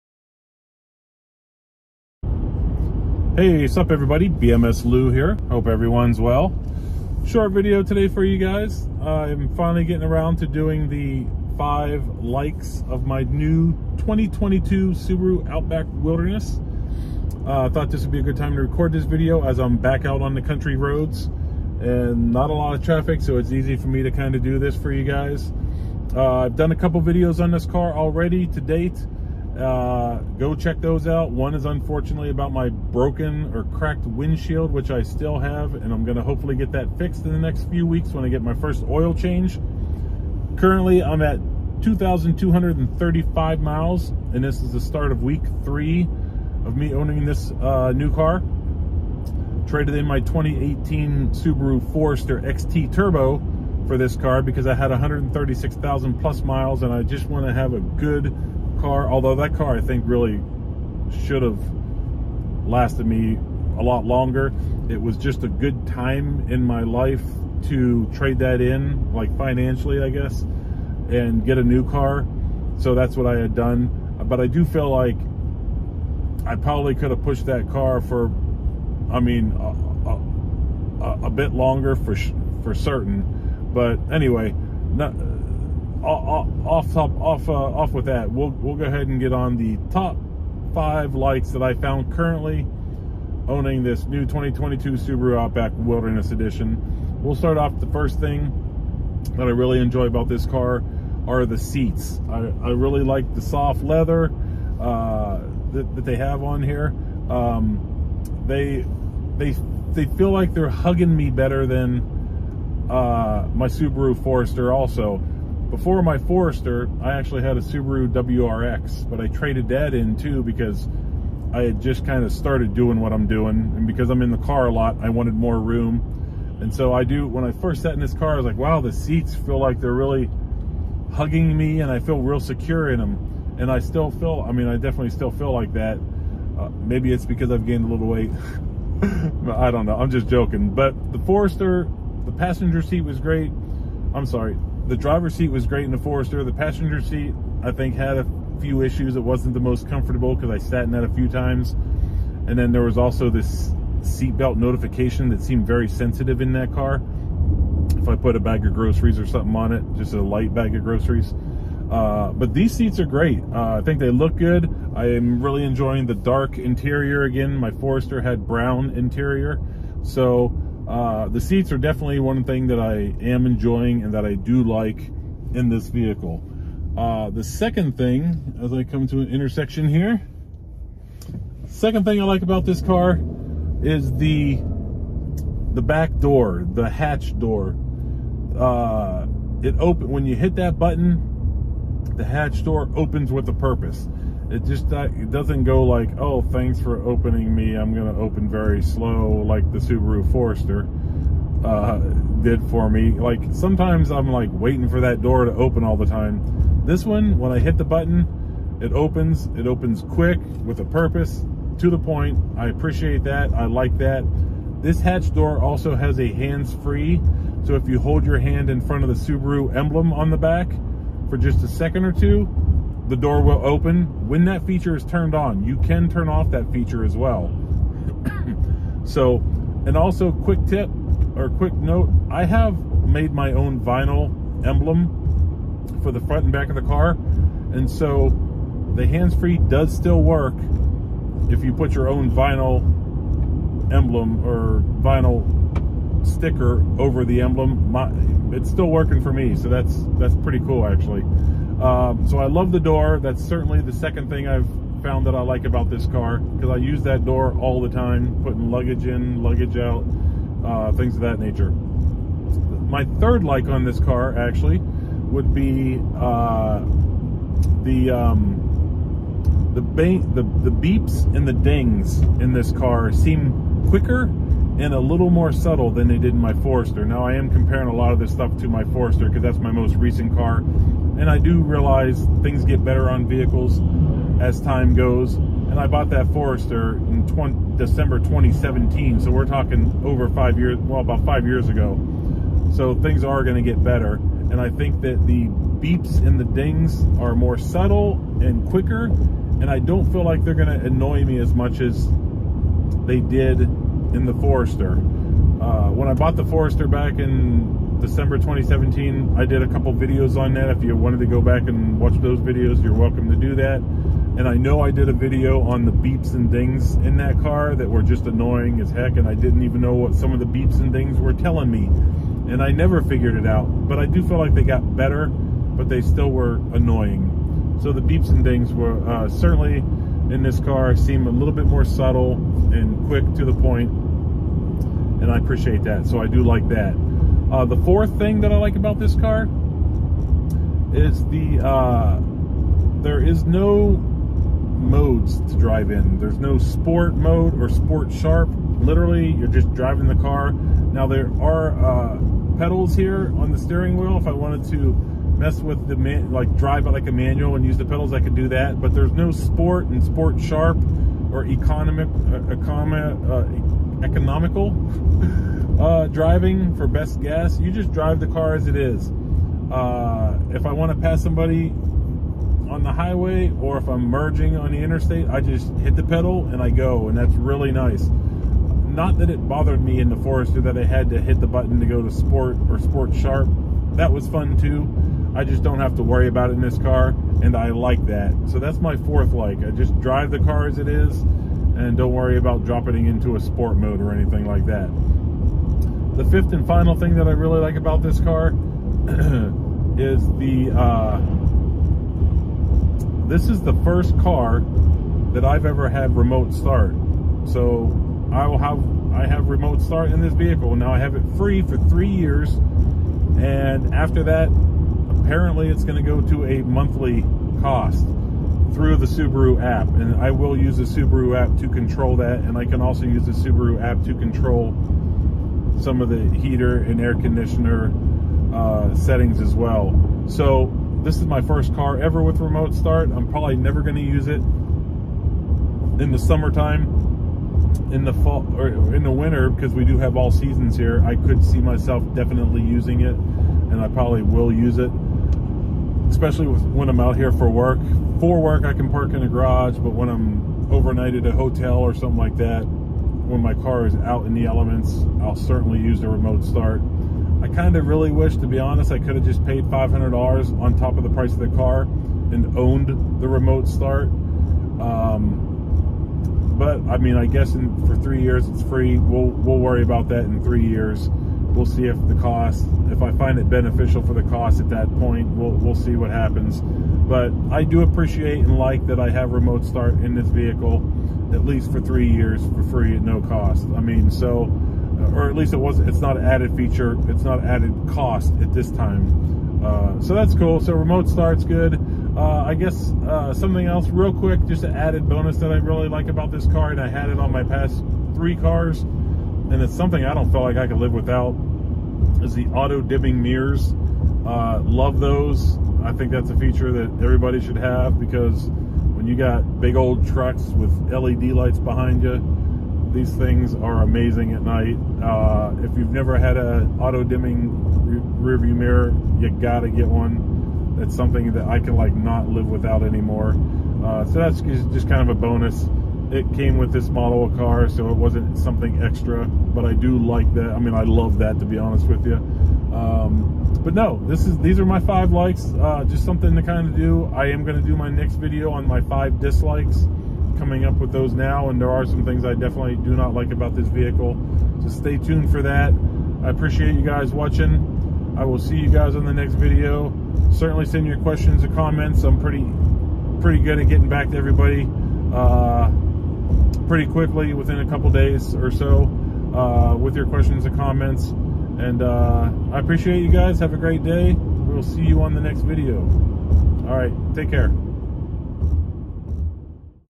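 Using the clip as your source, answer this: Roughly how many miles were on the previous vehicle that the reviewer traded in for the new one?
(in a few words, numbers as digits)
136,000.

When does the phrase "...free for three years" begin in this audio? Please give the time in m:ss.
6:51.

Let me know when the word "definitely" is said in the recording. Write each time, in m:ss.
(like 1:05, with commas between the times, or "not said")
2:14, 2:51, 7:22, 9:02.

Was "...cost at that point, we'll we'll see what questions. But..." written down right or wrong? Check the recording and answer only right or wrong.
wrong.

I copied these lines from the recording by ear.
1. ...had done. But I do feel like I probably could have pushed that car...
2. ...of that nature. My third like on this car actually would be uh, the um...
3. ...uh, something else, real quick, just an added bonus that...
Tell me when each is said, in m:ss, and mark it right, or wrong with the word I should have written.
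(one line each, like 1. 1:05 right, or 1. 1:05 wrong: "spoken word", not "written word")
1. 1:13 right
2. 4:21 right
3. 8:13 right.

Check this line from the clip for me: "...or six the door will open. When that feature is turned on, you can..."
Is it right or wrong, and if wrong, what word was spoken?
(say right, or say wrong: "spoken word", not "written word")
wrong: "two", not "six".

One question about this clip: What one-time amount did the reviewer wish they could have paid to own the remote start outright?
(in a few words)
$500.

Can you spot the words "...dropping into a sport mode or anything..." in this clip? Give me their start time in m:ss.
6:32.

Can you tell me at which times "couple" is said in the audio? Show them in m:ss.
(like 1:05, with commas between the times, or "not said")
0:26, 5:09, 9:17.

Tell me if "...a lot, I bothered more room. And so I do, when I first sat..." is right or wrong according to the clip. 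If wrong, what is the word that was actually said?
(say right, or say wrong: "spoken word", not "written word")
wrong: "wanted", not "bothered".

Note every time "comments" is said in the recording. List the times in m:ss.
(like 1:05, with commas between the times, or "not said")
9:11, 9:20.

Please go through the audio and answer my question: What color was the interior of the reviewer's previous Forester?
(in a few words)
Brown.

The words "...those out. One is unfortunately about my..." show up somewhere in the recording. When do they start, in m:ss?
0:30.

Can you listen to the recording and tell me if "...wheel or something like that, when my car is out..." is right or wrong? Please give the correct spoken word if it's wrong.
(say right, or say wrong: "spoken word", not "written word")
wrong: "hotel", not "wheel".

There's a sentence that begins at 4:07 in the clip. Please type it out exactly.
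My, it's still working for me, so that's that's pretty cool actually.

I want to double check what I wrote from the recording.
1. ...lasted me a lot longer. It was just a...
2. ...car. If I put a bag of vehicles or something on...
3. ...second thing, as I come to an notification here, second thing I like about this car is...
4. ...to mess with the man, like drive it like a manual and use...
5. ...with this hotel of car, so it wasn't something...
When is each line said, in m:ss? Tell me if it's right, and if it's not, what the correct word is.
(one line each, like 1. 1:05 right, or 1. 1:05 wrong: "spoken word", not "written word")
1. 1:02 right
2. 2:36 wrong: "groceries", not "vehicles"
3. 2:57 wrong: "intersection", not "notification"
4. 5:54 right
5. 8:46 wrong: "model", not "hotel".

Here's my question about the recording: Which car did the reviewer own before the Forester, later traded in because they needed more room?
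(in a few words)
Subaru WRX.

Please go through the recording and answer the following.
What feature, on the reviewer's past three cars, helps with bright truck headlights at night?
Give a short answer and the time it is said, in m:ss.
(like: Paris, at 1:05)
Auto dimming mirrors, at 8:22.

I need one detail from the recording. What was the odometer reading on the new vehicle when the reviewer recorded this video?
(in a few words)
2,235 miles.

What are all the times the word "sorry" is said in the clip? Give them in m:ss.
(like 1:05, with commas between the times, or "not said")
2:24.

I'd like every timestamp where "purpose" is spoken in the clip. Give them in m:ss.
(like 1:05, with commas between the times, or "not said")
3:13, 3:30.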